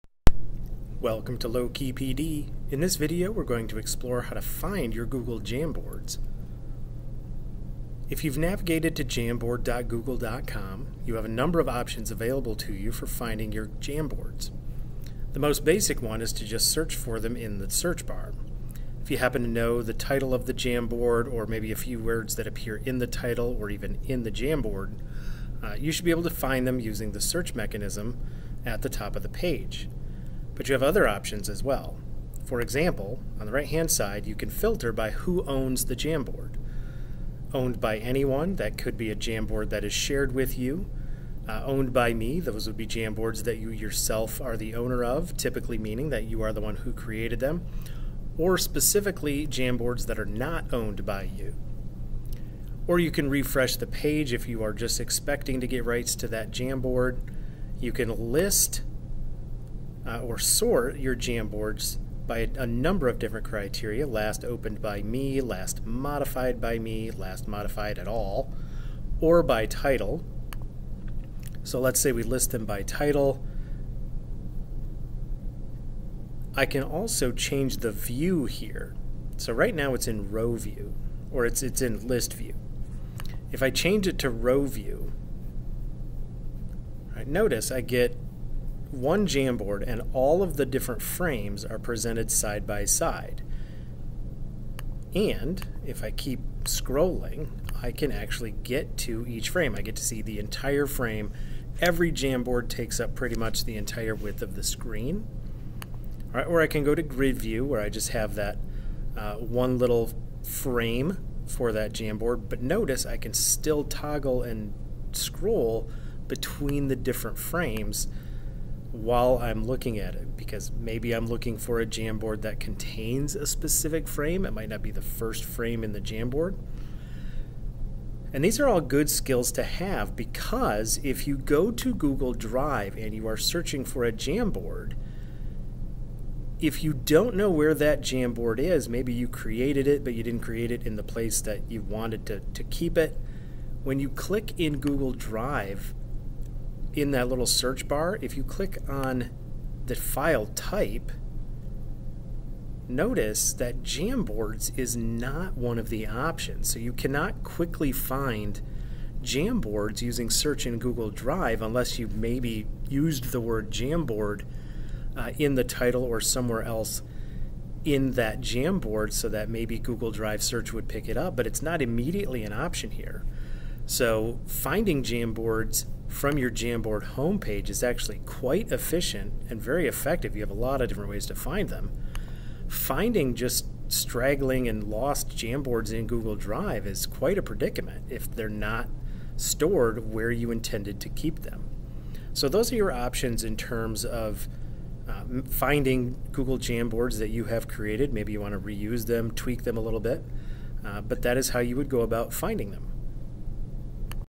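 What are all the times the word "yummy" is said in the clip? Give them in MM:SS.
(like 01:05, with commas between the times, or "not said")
not said.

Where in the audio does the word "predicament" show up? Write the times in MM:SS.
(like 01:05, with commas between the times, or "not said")
03:07.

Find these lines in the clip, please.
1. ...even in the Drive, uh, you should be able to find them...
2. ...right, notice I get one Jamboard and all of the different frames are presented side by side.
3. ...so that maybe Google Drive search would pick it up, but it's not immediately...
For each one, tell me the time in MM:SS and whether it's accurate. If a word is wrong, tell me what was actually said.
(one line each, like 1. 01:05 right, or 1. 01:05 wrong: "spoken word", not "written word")
1. 00:23 wrong: "Jamboard", not "Drive"
2. 01:27 right
3. 02:49 right.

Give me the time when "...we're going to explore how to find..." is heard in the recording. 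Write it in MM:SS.
00:03.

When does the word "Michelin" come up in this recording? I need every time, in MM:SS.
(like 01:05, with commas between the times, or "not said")
not said.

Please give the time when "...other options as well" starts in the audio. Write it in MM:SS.
00:30.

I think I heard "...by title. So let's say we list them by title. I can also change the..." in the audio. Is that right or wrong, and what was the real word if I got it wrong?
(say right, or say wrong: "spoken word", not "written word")
right.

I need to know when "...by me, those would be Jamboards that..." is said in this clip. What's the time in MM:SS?
00:41.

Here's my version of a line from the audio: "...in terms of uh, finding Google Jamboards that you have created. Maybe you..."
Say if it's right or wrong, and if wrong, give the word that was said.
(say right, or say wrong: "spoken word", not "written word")
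right.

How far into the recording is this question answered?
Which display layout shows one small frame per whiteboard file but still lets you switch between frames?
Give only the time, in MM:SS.
01:47.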